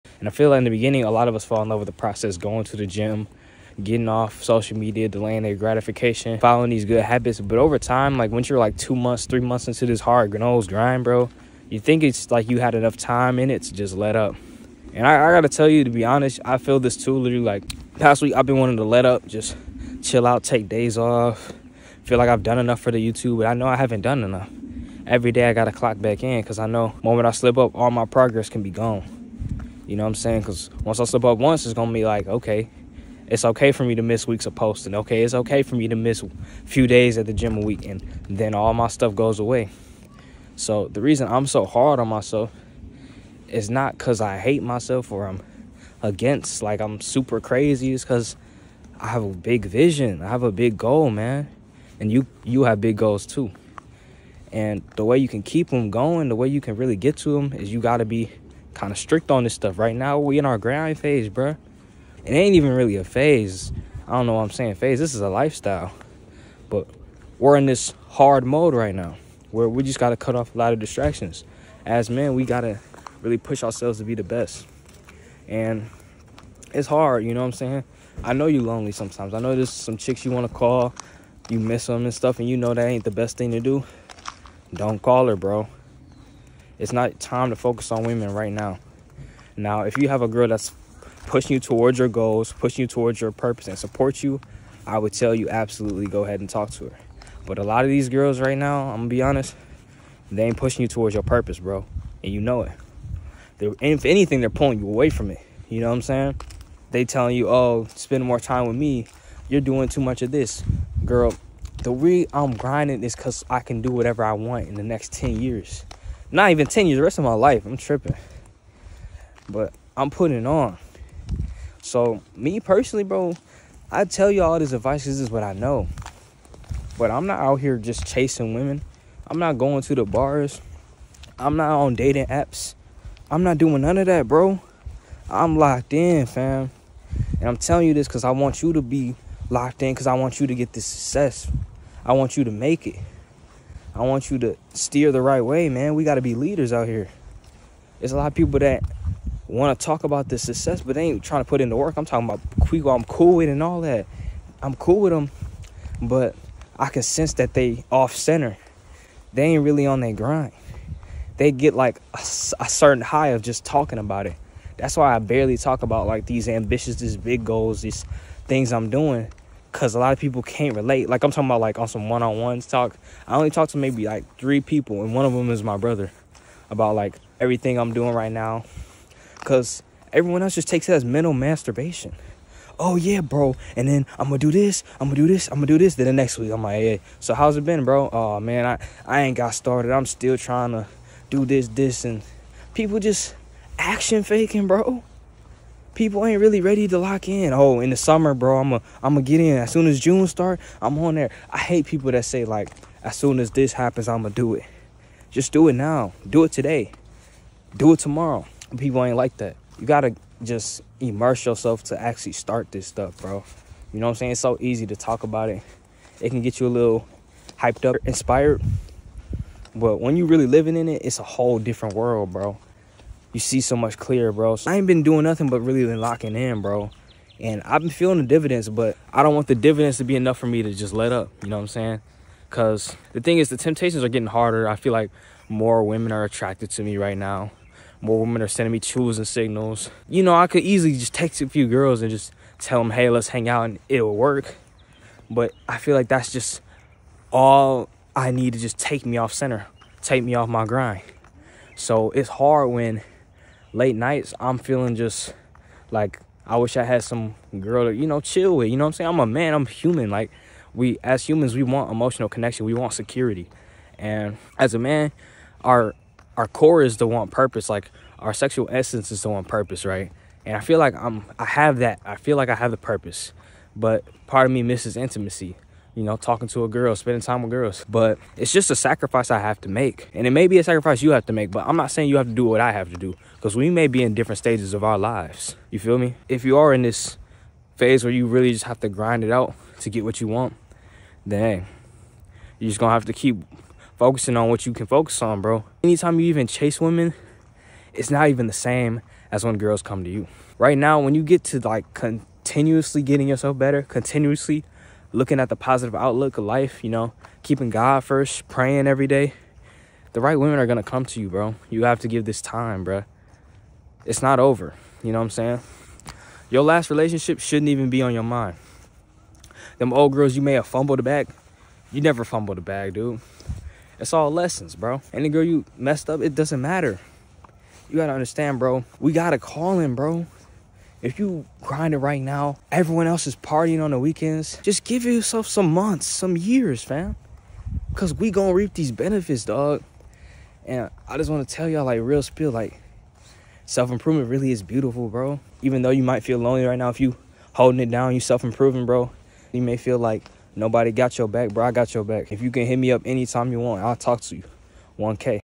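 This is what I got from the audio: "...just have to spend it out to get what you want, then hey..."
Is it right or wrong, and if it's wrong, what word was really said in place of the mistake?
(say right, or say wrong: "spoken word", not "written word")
wrong: "grind", not "spend".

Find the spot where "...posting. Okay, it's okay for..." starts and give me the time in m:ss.
0:34.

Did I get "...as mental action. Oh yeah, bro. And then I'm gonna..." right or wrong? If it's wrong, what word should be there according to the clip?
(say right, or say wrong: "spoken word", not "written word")
wrong: "masturbation", not "action".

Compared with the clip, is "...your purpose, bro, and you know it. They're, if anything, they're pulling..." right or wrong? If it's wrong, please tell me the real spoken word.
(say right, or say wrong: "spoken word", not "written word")
right.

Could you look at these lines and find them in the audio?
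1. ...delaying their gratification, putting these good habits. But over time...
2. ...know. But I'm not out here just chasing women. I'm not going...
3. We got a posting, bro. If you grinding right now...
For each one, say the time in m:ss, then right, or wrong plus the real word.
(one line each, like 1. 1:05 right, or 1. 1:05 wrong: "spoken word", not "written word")
1. 0:05 wrong: "following", not "putting"
2. 2:05 right
3. 5:28 wrong: "calling", not "posting".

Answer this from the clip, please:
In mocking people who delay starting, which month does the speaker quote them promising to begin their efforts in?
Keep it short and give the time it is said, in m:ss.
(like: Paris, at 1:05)
June, at 3:19.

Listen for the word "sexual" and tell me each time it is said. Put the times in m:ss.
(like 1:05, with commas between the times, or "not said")
4:28.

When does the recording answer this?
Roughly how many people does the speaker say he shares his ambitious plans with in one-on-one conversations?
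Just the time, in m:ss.
2:54.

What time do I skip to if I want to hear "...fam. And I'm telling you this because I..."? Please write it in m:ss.
2:16.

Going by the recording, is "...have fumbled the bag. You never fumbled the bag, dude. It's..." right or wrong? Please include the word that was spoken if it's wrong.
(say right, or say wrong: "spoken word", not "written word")
right.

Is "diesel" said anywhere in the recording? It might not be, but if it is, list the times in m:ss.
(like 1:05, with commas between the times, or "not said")
not said.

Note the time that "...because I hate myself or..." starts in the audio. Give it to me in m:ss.
0:43.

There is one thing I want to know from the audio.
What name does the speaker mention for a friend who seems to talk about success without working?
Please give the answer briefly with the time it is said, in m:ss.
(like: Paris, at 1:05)
Quico, at 2:32.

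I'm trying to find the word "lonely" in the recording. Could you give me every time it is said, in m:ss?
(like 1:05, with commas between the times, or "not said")
1:18, 5:46.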